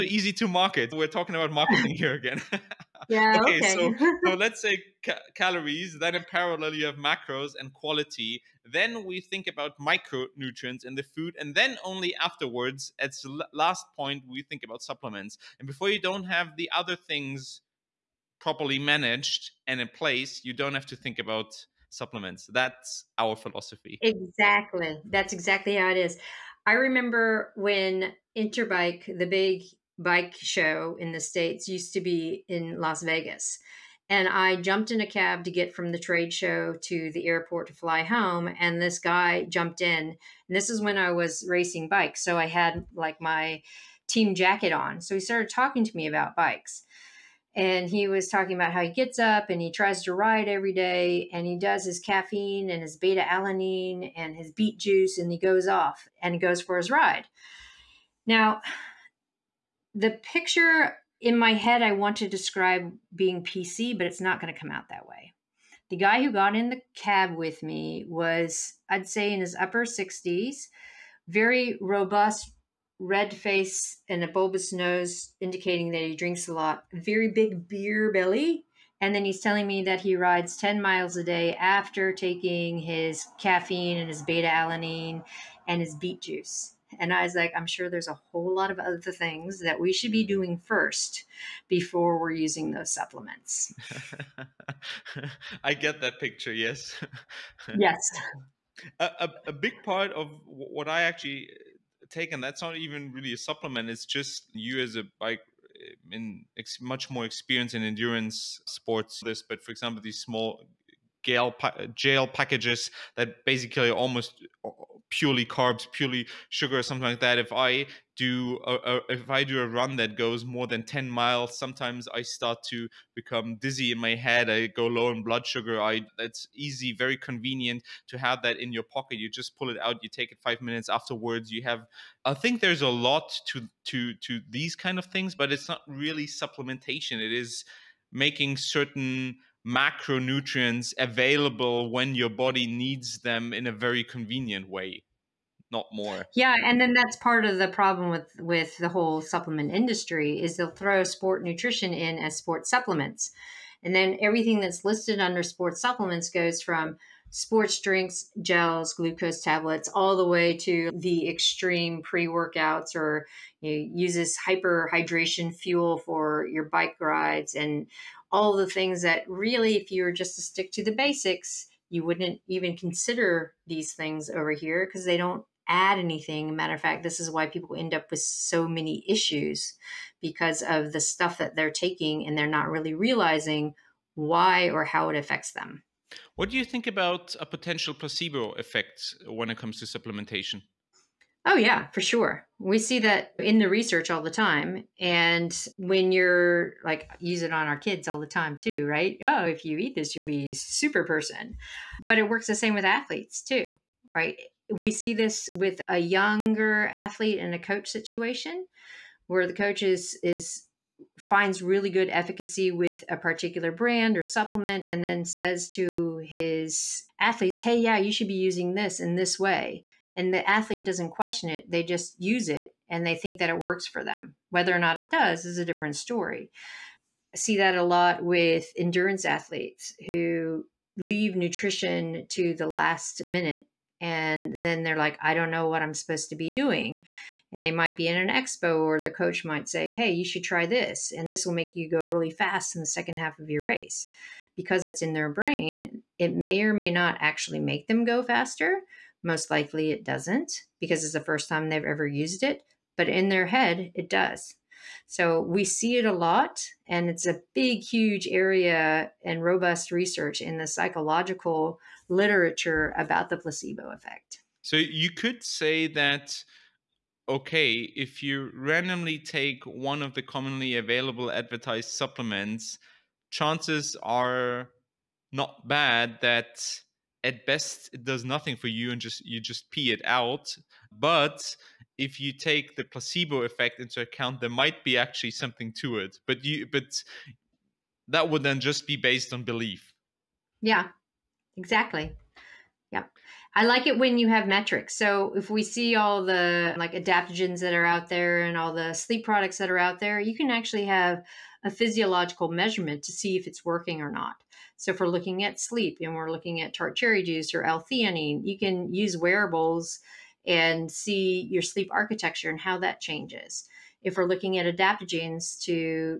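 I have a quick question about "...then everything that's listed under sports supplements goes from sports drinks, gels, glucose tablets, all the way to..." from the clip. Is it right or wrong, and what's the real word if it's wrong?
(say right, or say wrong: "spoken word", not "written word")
right.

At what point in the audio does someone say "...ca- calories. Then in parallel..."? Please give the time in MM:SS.
00:05.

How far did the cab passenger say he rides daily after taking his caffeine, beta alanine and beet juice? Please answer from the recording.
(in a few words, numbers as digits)
10 miles.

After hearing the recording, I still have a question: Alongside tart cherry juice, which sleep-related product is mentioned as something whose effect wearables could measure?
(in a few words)
L-theanine.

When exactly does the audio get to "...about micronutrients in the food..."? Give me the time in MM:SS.
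00:09.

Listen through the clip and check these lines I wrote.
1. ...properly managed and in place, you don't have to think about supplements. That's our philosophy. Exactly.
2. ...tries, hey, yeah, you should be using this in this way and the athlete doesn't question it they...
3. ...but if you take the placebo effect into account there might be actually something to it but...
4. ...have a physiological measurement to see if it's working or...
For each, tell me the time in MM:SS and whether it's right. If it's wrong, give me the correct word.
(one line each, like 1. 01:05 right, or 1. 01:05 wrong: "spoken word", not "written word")
1. 00:18 right
2. 03:37 wrong: "athletes", not "tries"
3. 04:40 right
4. 05:00 right.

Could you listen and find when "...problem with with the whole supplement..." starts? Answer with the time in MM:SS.
02:27.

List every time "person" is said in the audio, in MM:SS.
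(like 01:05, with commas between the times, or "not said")
03:21.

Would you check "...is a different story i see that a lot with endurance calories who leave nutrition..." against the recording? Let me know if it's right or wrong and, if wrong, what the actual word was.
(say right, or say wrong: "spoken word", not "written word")
wrong: "athletes", not "calories".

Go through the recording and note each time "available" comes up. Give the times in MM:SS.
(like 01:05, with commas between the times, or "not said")
02:20, 04:30.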